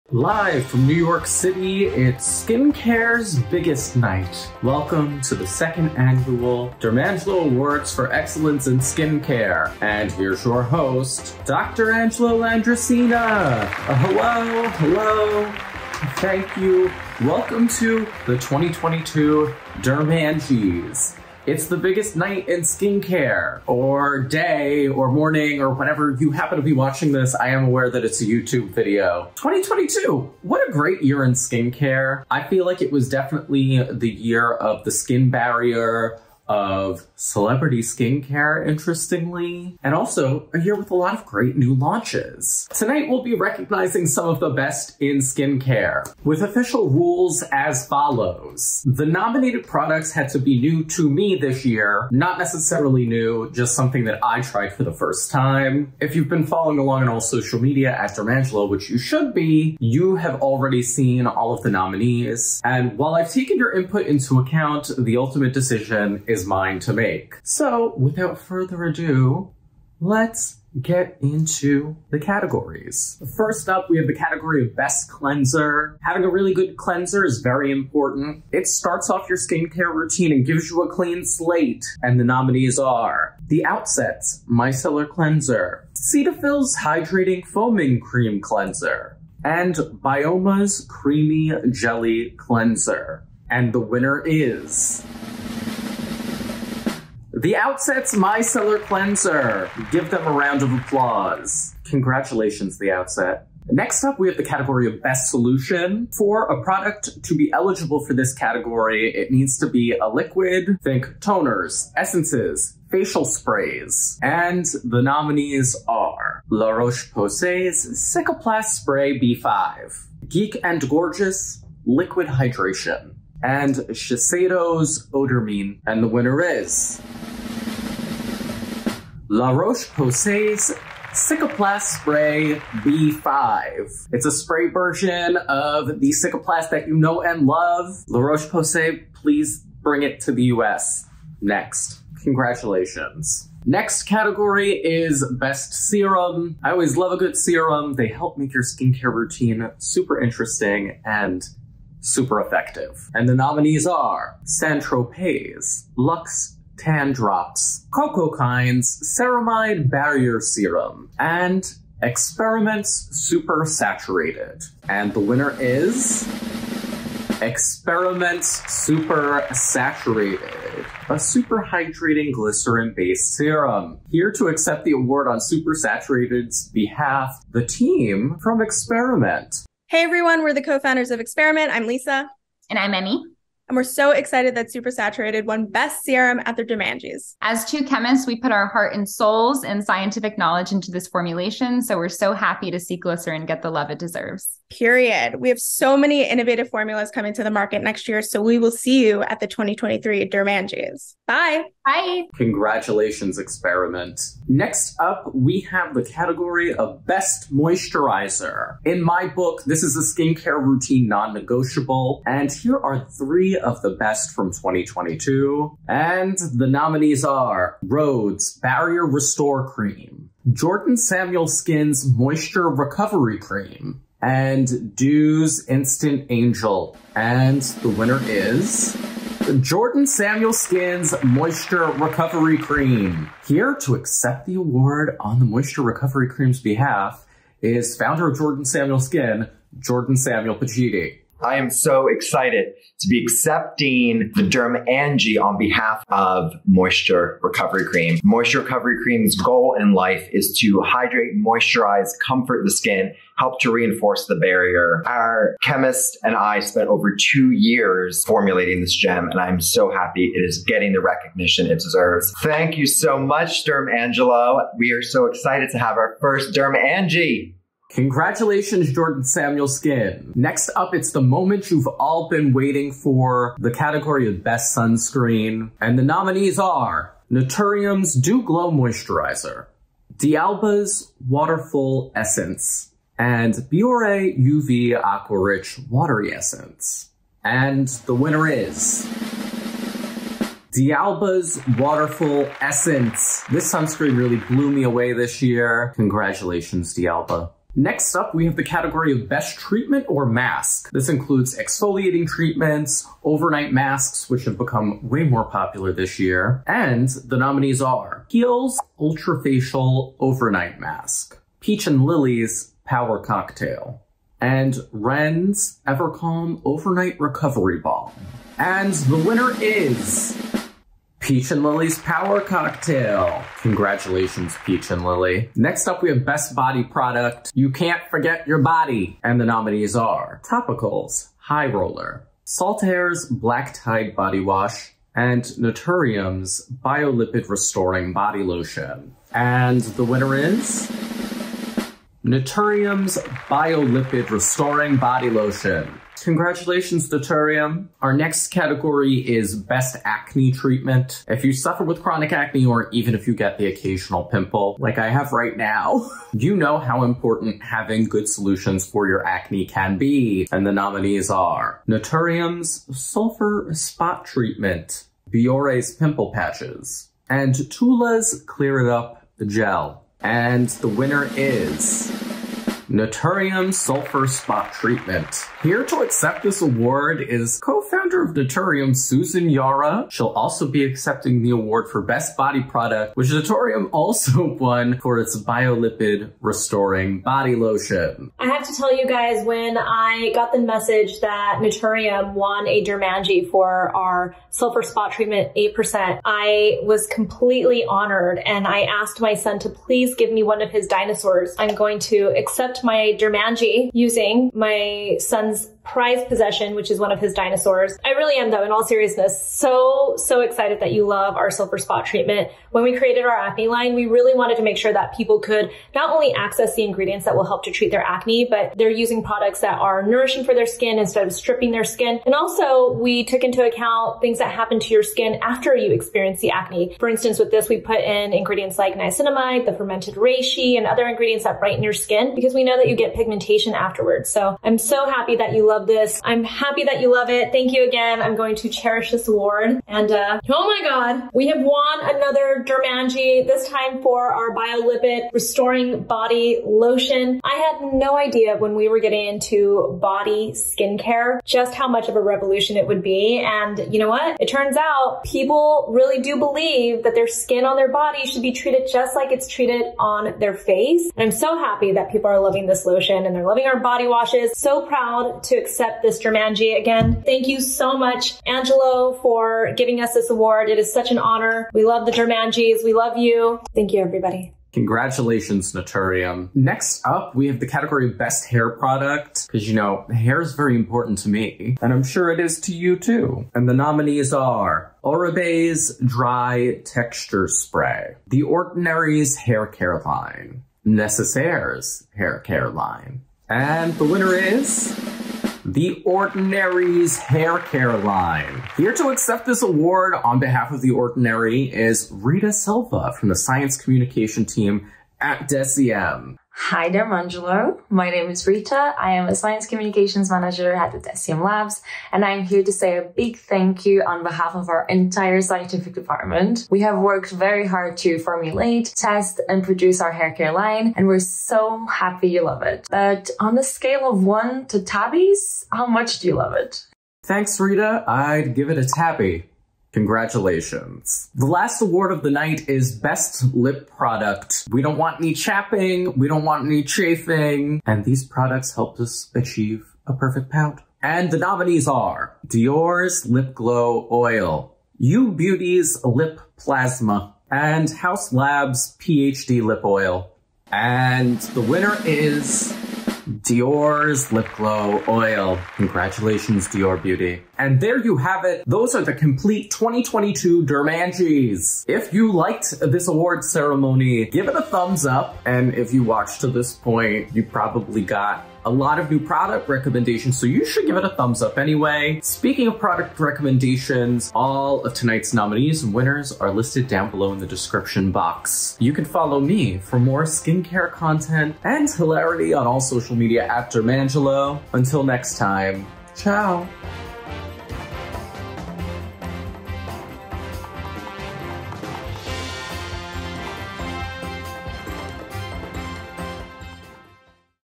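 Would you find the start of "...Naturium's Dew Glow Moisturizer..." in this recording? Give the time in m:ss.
4:37.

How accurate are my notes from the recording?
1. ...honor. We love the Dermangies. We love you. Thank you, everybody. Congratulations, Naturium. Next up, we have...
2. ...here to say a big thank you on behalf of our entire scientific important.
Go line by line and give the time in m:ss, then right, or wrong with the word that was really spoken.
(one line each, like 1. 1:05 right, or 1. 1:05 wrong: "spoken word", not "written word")
1. 7:51 right
2. 8:32 wrong: "department", not "important".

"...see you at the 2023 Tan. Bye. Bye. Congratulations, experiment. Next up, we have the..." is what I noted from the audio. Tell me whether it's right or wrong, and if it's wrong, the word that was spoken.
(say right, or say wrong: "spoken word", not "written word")
wrong: "Dermangies", not "Tan".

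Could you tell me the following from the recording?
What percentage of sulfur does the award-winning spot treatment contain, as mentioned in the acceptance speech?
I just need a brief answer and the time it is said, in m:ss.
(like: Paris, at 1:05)
8%, at 6:35.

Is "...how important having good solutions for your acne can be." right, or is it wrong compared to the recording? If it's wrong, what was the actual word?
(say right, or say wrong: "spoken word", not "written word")
right.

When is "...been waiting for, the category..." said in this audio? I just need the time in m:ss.
4:32.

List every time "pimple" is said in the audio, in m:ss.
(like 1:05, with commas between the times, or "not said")
5:54, 6:05.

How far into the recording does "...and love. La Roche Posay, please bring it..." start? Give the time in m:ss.
2:17.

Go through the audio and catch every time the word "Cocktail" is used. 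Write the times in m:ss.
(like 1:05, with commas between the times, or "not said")
5:13, 5:22.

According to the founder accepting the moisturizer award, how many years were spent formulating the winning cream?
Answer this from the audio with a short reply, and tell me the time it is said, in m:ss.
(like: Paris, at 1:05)
over 2 years, at 4:16.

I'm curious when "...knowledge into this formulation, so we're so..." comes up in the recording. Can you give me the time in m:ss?
3:10.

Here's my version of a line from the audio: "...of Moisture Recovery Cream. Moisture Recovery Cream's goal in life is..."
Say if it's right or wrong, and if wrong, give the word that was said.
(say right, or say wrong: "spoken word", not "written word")
right.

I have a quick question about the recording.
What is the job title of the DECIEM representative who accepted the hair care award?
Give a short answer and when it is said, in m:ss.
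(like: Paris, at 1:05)
Science Communications Manager, at 8:29.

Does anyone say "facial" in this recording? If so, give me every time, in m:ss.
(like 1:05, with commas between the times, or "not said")
1:52, 5:09.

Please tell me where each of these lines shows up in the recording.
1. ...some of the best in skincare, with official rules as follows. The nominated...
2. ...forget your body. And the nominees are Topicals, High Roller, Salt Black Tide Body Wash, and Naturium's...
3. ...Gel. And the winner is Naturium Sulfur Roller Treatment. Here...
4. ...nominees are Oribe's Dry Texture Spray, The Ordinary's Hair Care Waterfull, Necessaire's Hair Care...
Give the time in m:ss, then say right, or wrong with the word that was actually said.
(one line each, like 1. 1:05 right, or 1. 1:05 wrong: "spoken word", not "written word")
1. 0:44 right
2. 5:28 right
3. 6:09 wrong: "Spot", not "Roller"
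4. 8:03 wrong: "Line", not "Waterfull".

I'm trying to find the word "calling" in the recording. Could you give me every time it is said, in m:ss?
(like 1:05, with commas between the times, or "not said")
not said.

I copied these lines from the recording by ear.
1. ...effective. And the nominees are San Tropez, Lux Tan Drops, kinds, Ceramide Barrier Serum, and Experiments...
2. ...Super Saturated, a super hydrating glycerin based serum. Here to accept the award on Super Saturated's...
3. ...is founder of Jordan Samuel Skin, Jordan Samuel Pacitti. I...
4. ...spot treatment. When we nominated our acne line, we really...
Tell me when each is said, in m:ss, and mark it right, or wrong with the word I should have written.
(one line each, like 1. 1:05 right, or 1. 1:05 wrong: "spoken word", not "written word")
1. 2:32 right
2. 2:48 right
3. 3:57 right
4. 6:51 wrong: "created", not "nominated".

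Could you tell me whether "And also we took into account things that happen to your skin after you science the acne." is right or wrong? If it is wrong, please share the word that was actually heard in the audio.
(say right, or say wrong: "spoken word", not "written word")
wrong: "experience", not "science".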